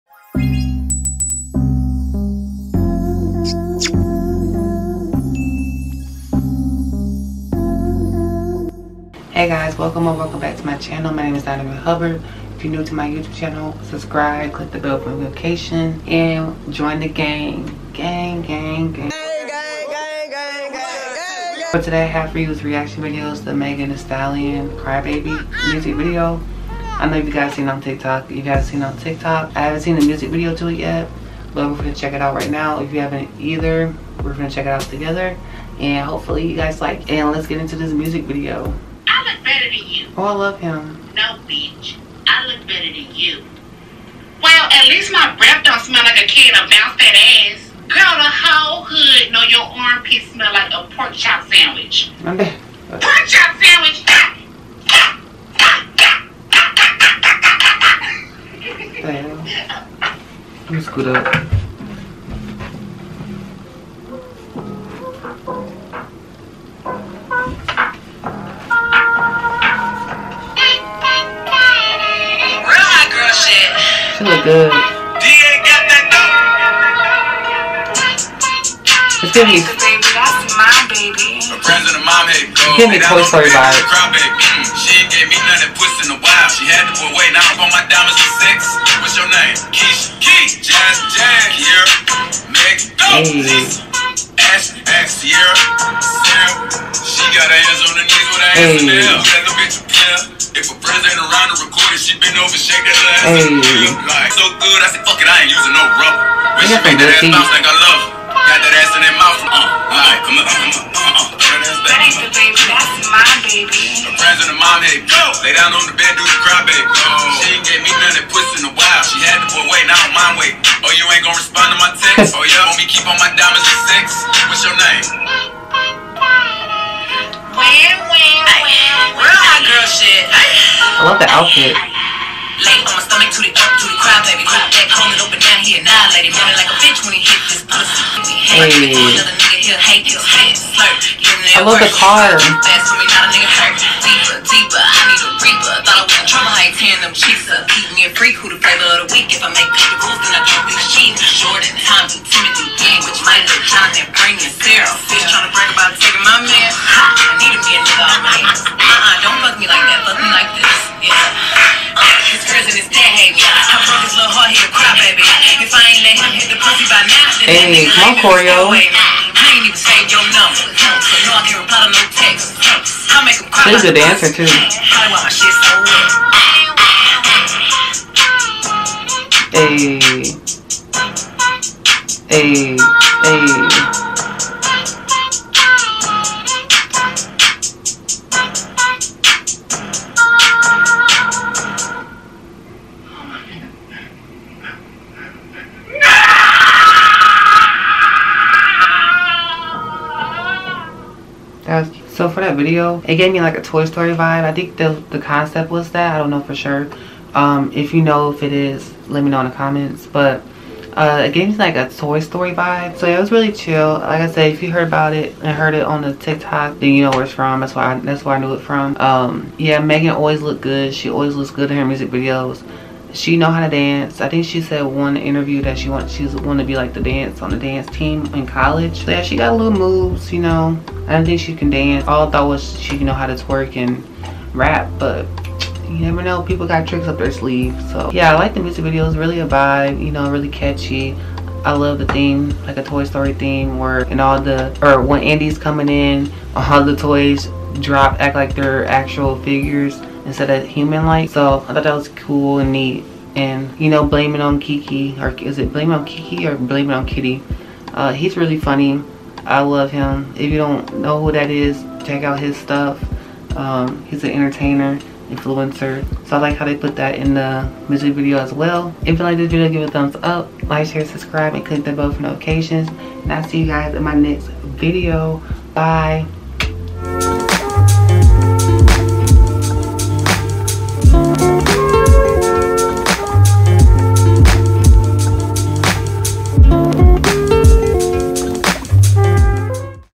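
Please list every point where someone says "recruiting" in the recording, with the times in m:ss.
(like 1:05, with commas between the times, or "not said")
not said.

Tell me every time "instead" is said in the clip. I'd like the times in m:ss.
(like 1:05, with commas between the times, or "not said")
4:10.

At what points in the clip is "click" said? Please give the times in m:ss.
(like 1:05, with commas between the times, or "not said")
0:14, 4:31.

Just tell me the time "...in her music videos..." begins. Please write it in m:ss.
3:41.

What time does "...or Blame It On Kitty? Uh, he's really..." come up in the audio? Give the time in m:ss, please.
4:16.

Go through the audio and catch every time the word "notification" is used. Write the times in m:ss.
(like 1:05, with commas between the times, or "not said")
0:15, 4:32.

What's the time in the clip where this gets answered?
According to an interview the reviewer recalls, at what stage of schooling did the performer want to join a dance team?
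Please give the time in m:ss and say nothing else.
3:48.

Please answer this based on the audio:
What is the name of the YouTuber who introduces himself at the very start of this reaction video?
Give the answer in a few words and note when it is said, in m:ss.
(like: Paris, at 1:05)
Donovan Hubbard, at 0:11.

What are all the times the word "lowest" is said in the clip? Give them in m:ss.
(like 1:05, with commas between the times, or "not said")
not said.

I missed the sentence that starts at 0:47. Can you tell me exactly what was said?
Girl, the whole hood know your armpit smell like a pork chop sandwich.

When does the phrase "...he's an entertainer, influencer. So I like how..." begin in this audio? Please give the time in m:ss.
4:24.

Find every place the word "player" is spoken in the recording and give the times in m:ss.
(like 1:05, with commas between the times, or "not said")
1:39.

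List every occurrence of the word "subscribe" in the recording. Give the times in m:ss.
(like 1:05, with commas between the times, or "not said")
0:13, 4:31.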